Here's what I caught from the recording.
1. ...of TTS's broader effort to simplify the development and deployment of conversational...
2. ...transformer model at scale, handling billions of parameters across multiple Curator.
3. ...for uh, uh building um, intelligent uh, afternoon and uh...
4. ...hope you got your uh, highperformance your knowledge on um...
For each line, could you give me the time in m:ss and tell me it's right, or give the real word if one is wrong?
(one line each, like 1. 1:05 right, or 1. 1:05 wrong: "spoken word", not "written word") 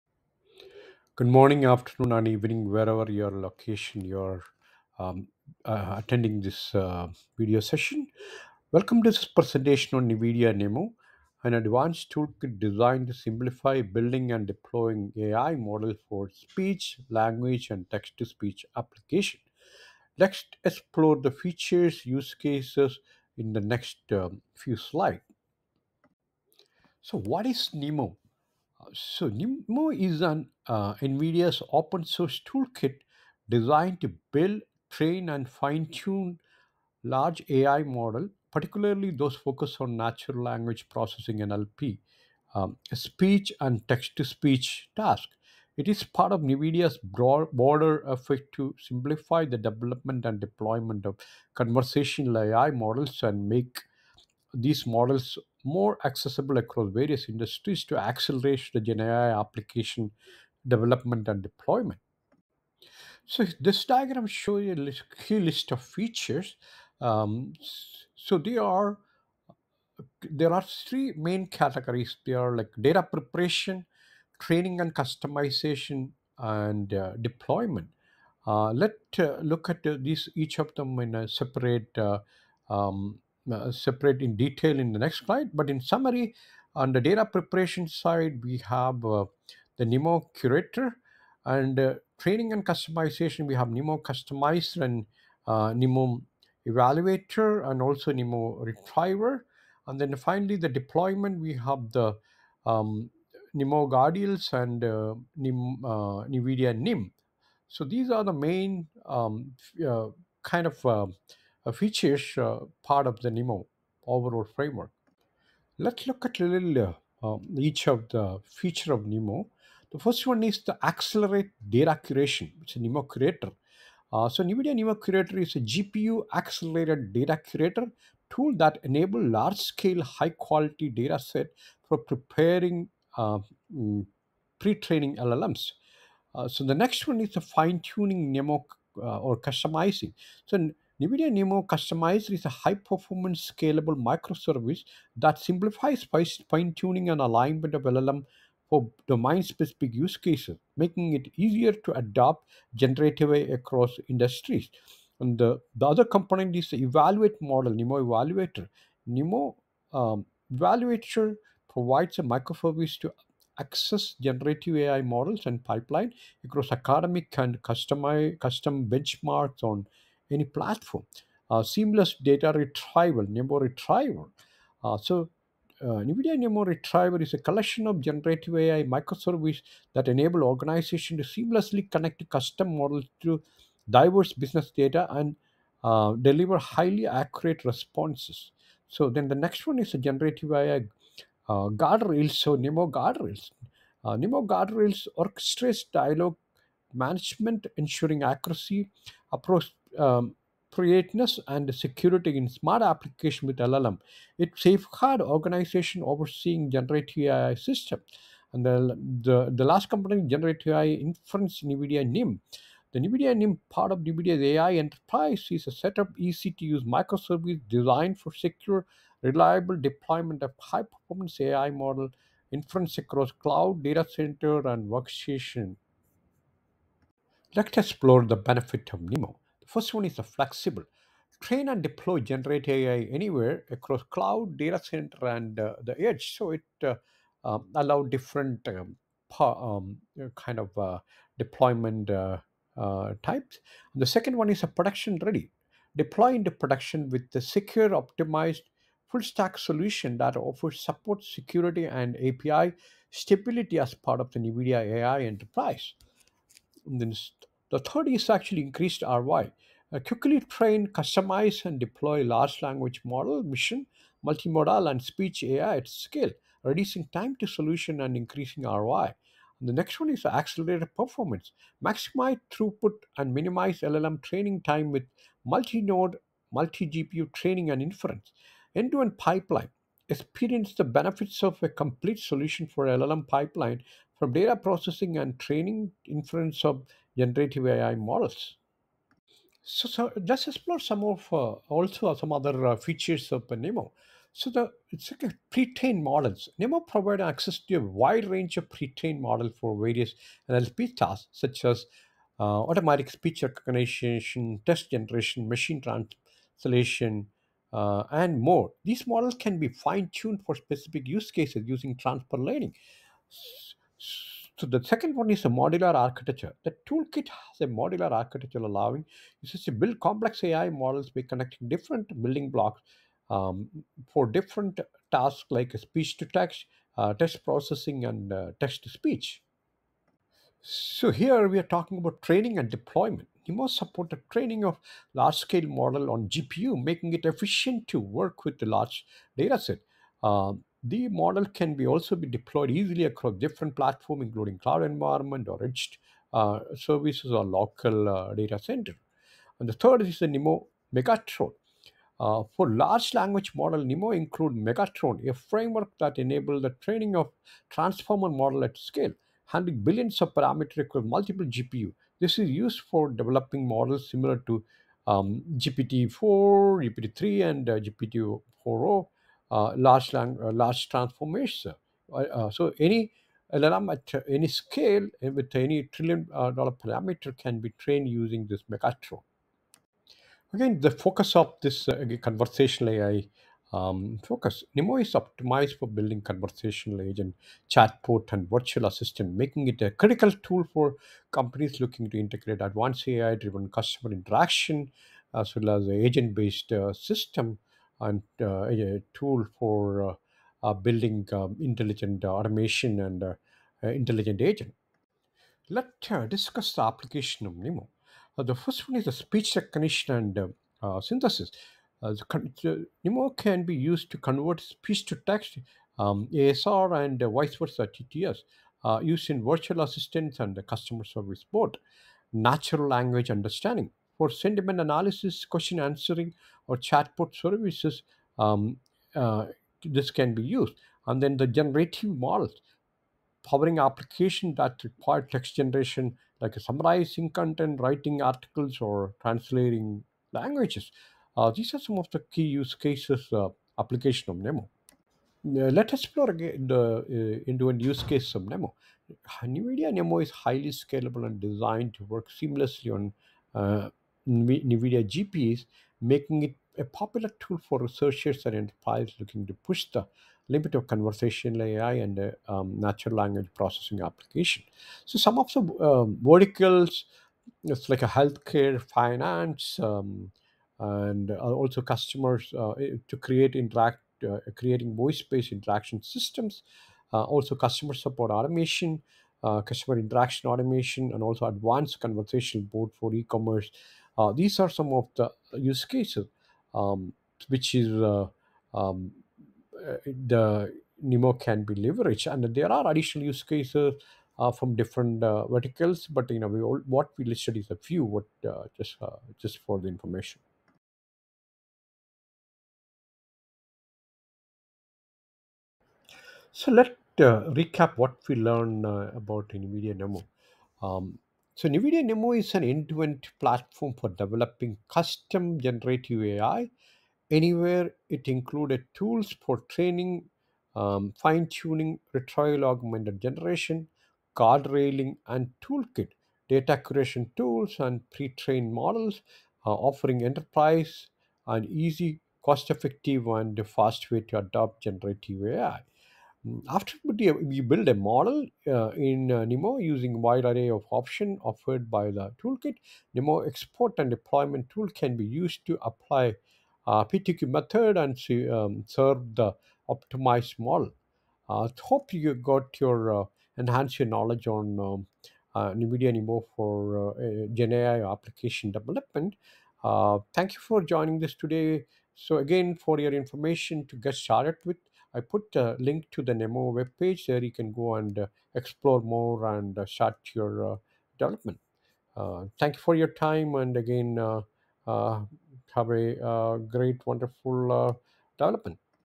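1. 0:46 wrong: "NVIDIA", not "TTS"
2. 5:57 wrong: "GPU", not "Curator"
3. 6:39 wrong: "automation", not "afternoon"
4. 9:11 wrong: "enhance", not "highperformance".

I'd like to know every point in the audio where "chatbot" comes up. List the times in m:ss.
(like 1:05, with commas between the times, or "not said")
6:27, 7:06.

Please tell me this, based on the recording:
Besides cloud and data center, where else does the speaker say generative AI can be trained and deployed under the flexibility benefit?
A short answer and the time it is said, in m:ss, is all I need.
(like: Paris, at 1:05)
the edge, at 3:55.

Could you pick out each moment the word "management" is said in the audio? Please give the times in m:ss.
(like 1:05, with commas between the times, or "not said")
3:16.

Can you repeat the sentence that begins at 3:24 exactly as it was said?
It safeguard organization overseeing generative AI system.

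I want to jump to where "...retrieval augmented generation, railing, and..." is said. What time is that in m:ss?
8:42.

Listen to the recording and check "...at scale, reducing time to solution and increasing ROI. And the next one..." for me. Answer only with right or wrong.
right.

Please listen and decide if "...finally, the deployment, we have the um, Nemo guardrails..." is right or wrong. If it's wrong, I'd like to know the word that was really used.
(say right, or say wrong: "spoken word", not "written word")
right.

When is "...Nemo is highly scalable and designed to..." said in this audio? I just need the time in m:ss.
7:29.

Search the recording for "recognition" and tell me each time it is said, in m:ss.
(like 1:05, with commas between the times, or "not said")
5:03, 6:49.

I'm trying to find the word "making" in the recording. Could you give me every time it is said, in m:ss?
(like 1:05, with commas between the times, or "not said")
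2:30, 5:36, 6:29, 7:36.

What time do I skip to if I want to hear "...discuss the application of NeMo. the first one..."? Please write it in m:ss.
6:46.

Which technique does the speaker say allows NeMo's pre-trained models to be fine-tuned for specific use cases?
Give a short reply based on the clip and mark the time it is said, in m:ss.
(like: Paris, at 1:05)
transfer learning, at 5:11.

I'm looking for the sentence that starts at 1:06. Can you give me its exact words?
Um, so there are there are three main categories.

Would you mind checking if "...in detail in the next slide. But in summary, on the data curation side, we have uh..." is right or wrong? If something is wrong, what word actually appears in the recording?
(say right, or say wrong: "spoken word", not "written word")
wrong: "preparation", not "curation".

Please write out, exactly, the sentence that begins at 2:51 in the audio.
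Uh, seamless data retrieval, Nemo retrieval.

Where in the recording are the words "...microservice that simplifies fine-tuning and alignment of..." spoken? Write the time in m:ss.
2:23.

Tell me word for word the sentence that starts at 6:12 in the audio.
Uh, so any LLM at any scale with any trillion dollar parameter can be trained using this Megatron.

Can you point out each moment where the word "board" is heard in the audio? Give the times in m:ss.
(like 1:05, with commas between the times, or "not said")
7:01, 8:02.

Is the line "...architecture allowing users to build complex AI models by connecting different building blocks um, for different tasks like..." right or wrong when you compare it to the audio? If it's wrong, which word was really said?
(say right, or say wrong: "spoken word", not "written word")
right.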